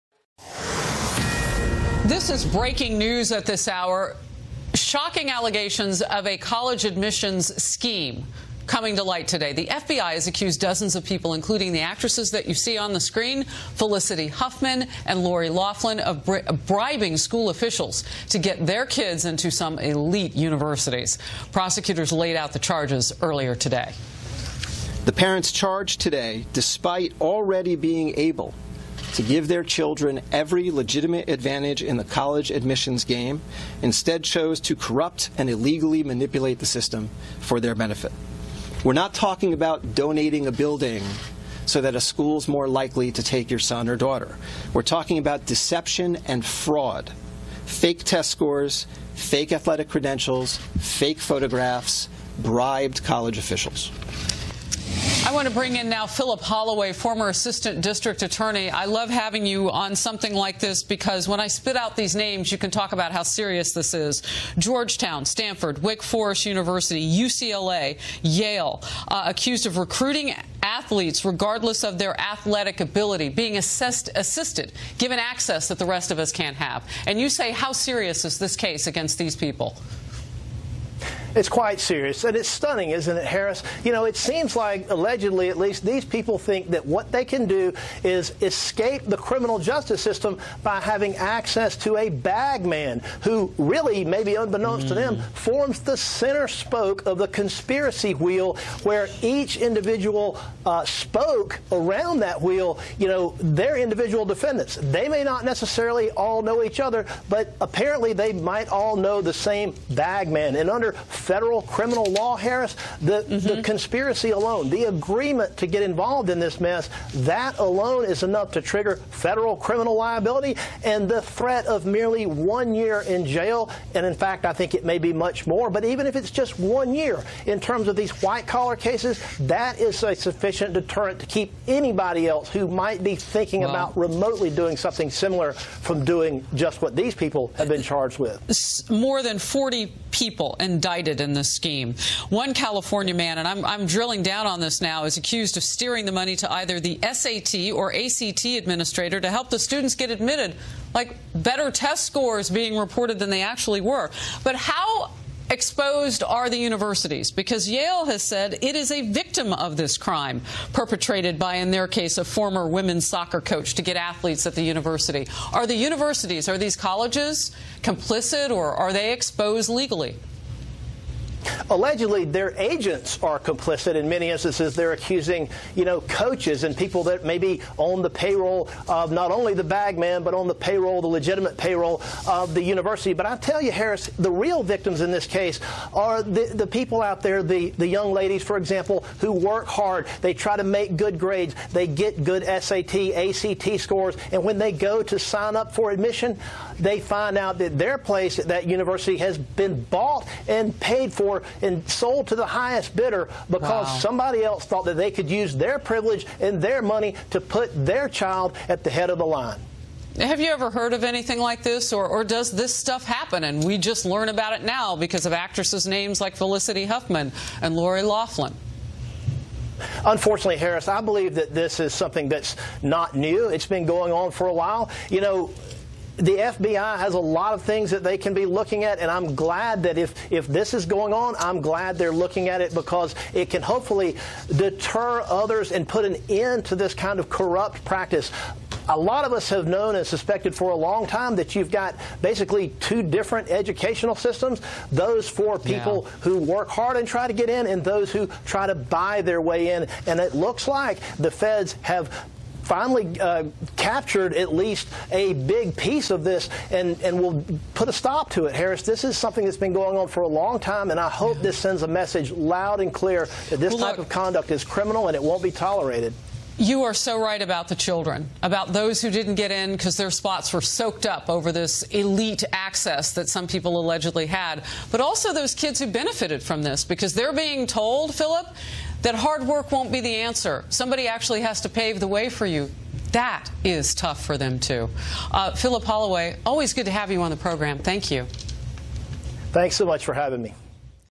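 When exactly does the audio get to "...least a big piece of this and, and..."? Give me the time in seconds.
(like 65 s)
254 s.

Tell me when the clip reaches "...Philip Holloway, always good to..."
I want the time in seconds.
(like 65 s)
285 s.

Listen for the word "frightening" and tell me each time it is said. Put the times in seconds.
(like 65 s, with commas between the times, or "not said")
not said.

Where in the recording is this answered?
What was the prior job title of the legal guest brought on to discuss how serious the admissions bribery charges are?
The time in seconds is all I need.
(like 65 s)
56 s.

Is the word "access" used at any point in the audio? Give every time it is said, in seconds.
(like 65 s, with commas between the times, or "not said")
75 s, 91 s, 272 s.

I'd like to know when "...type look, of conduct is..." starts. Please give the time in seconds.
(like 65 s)
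263 s.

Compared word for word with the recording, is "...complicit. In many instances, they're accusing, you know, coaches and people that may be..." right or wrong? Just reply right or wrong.
right.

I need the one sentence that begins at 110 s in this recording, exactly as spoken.
And under federal criminal law, Harris, the, mm-hmm.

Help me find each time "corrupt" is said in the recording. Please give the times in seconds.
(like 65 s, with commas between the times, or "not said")
34 s, 237 s.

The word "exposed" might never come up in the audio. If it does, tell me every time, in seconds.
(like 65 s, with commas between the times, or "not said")
155 s, 169 s.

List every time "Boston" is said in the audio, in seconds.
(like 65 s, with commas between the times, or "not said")
not said.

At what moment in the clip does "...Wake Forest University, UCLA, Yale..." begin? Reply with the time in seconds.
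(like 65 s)
65 s.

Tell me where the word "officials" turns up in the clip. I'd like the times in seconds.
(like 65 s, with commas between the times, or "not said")
17 s, 53 s.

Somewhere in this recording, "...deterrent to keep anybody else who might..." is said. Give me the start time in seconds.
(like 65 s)
130 s.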